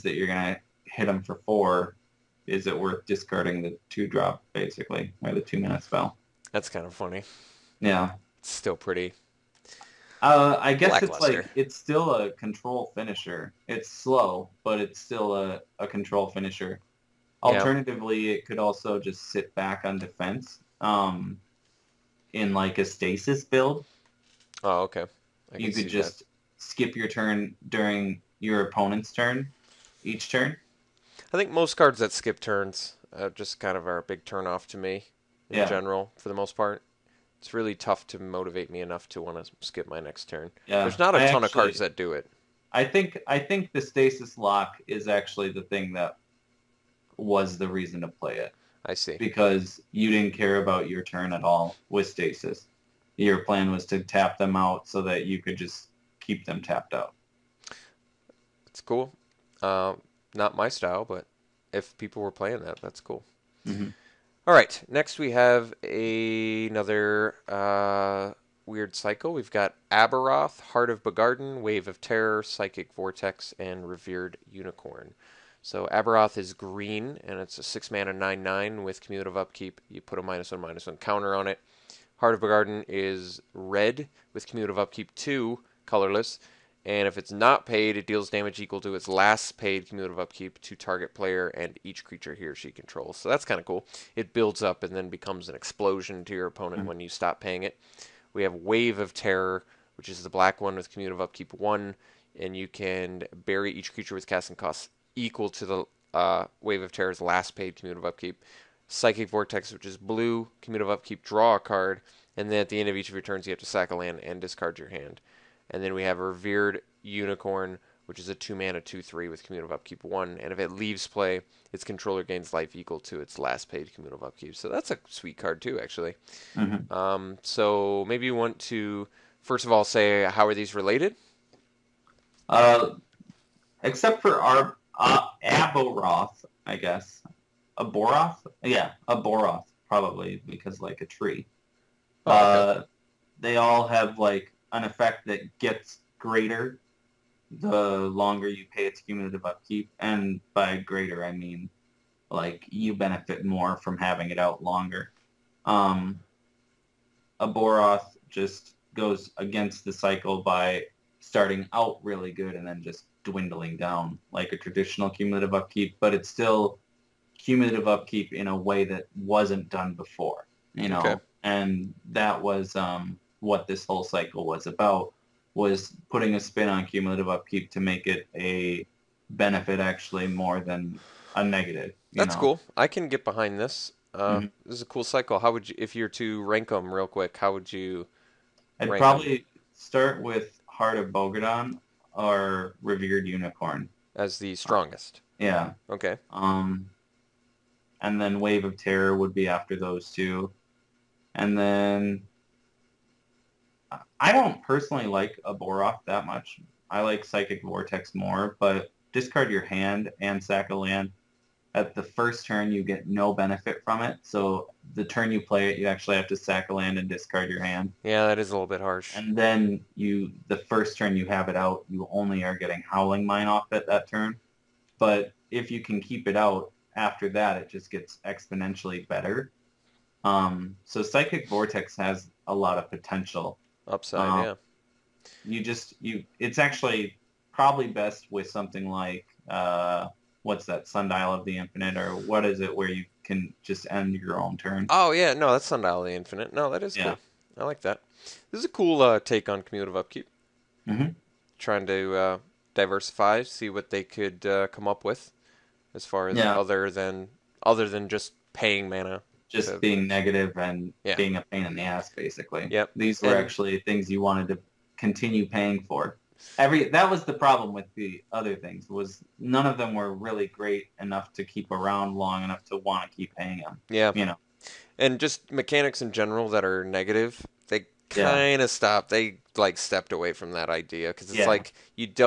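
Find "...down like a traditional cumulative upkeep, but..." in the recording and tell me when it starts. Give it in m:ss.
2:43.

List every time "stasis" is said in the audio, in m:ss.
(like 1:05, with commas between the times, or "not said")
0:22, 0:43, 0:52.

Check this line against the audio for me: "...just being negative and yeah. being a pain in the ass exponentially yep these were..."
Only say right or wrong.
wrong.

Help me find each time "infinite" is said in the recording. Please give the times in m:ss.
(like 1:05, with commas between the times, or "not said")
4:01, 4:06.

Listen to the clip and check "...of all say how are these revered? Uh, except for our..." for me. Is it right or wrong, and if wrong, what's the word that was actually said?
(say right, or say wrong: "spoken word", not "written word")
wrong: "related", not "revered".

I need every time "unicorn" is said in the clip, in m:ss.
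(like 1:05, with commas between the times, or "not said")
1:14, 1:57, 3:13.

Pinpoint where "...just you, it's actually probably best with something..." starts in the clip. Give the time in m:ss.
3:55.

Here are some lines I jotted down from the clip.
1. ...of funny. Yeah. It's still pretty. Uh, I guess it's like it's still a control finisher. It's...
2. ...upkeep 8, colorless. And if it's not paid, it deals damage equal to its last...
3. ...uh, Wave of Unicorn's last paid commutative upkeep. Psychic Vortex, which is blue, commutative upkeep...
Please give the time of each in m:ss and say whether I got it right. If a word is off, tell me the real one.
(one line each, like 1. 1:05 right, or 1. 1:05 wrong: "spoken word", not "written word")
1. 0:06 right
2. 1:24 wrong: "2", not "8"
3. 1:46 wrong: "Terror", not "Unicorn".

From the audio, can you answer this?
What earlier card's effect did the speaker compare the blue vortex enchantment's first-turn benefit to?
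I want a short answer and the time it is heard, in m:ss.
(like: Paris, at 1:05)
Howling Mine, at 3:42.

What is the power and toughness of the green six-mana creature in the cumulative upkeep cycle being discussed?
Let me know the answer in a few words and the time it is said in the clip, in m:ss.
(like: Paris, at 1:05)
9/9, at 1:18.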